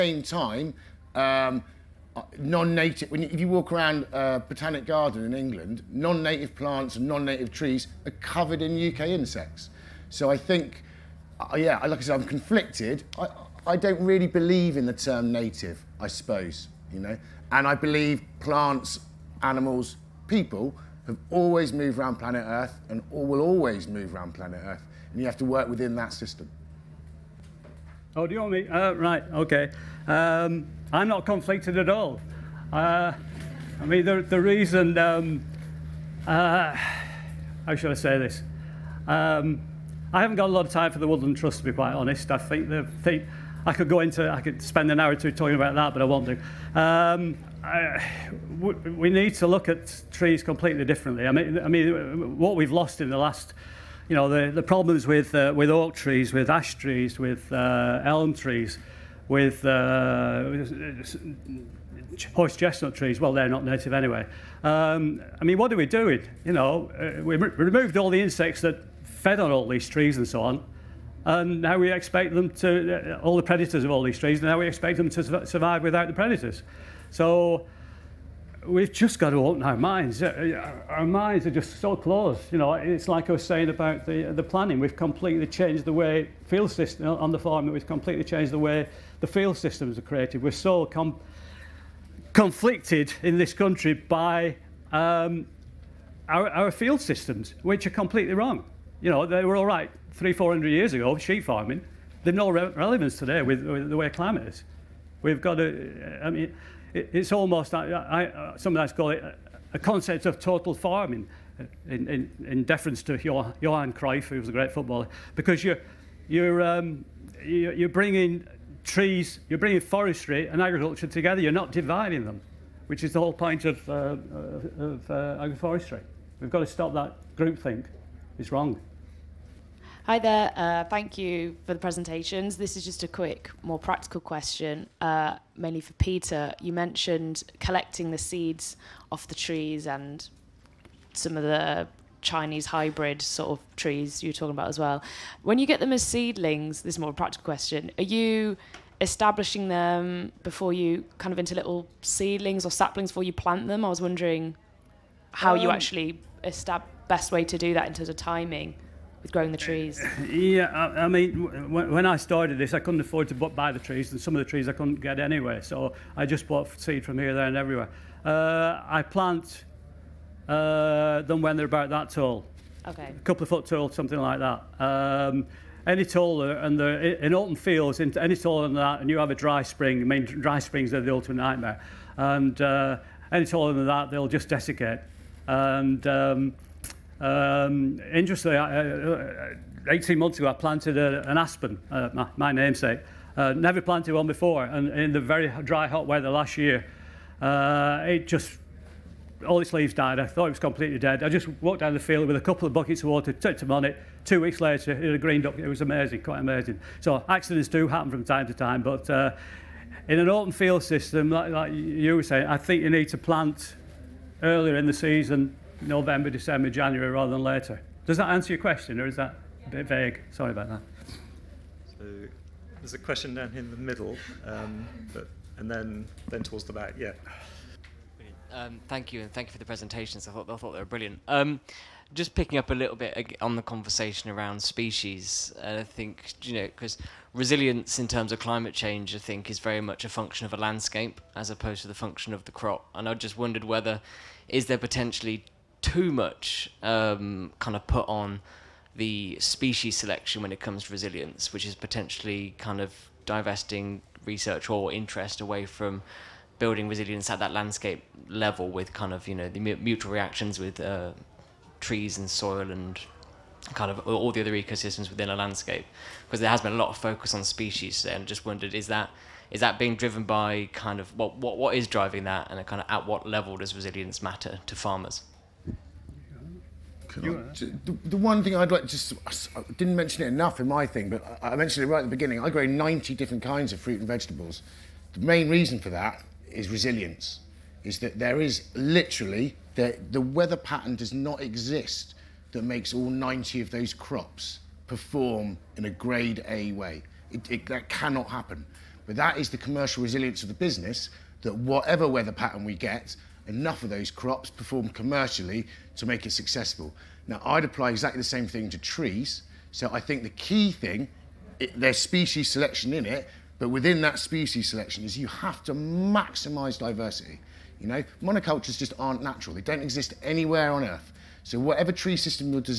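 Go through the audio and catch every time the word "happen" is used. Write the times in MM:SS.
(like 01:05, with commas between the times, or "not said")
03:27, 04:58.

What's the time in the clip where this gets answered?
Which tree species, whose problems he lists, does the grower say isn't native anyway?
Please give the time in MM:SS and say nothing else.
01:02.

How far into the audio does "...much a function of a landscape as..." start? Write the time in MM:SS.
03:59.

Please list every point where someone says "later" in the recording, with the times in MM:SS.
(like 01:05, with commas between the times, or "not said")
03:24, 03:37.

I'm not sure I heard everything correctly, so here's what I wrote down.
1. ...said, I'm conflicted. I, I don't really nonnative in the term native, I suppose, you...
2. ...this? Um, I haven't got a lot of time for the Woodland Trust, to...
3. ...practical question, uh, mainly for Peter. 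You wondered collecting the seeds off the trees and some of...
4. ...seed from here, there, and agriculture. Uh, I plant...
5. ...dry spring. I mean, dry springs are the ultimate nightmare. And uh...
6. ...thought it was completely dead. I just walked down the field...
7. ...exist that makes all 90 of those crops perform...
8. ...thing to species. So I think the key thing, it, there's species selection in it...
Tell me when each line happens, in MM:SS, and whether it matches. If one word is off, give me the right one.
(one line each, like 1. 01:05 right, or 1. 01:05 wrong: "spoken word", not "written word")
1. 00:12 wrong: "believe", not "nonnative"
2. 00:38 right
3. 02:13 wrong: "mentioned", not "wondered"
4. 02:46 wrong: "everywhere", not "agriculture"
5. 02:59 right
6. 03:20 right
7. 04:51 right
8. 05:08 wrong: "trees", not "species".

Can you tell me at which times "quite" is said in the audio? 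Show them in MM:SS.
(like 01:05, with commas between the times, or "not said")
00:41, 03:26.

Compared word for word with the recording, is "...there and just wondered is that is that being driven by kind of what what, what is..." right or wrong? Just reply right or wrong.
right.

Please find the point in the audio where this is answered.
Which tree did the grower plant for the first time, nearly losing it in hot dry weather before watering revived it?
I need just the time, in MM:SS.
03:11.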